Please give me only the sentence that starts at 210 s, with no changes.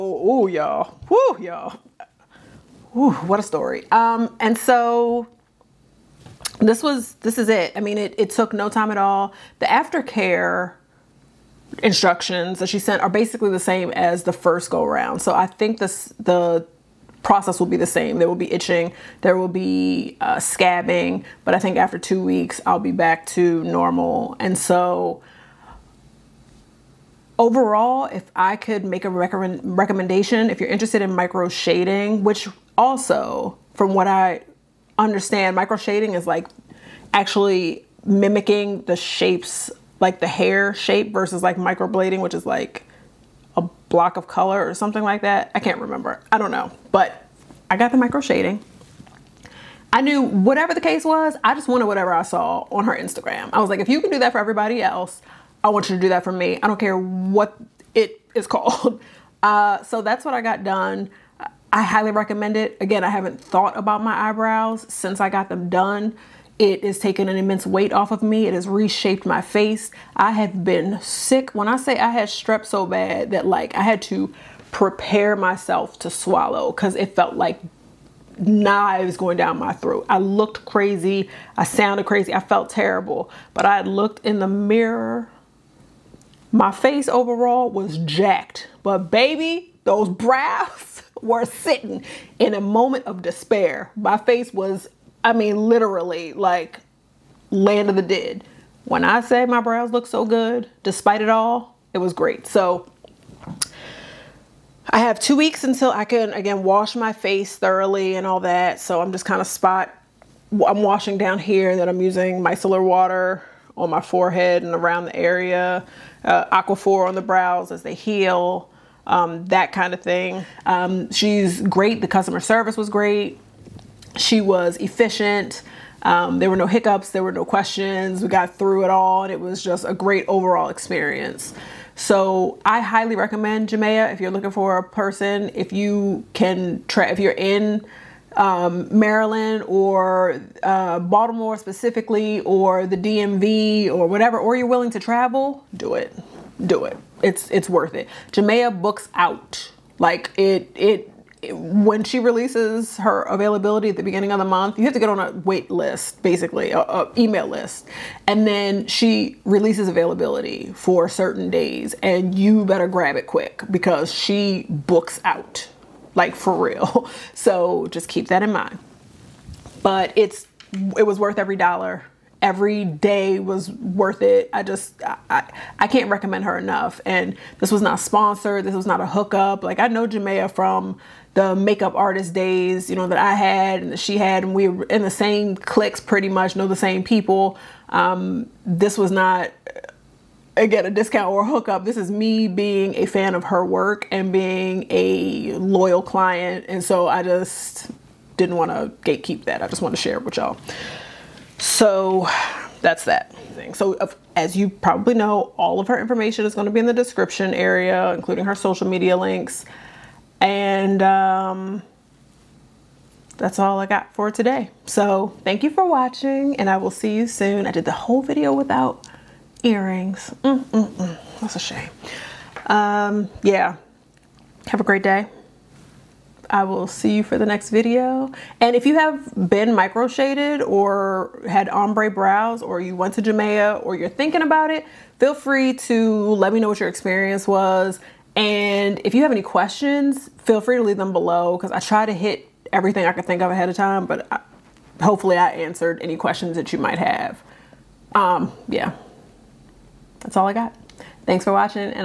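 And um, that's all I got for today.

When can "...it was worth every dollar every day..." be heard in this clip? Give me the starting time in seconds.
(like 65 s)
170 s.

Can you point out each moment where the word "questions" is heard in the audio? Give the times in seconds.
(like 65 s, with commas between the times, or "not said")
127 s, 239 s, 246 s.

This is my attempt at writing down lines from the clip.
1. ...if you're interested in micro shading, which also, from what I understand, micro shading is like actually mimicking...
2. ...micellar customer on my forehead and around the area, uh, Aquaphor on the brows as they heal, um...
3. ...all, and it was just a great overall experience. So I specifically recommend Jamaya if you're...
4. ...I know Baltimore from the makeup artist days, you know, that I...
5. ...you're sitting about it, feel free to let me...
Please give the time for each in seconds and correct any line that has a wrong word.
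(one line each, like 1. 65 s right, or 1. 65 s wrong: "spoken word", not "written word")
1. 30 s right
2. 112 s wrong: "water", not "customer"
3. 128 s wrong: "highly", not "specifically"
4. 179 s wrong: "Jamaya", not "Baltimore"
5. 233 s wrong: "thinking", not "sitting".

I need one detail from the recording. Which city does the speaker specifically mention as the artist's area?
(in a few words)
Baltimore.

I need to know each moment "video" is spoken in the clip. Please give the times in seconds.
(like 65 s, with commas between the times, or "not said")
218 s, 227 s.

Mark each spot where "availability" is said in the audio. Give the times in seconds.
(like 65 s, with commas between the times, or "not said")
153 s, 159 s.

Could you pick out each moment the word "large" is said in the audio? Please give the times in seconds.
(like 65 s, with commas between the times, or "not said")
not said.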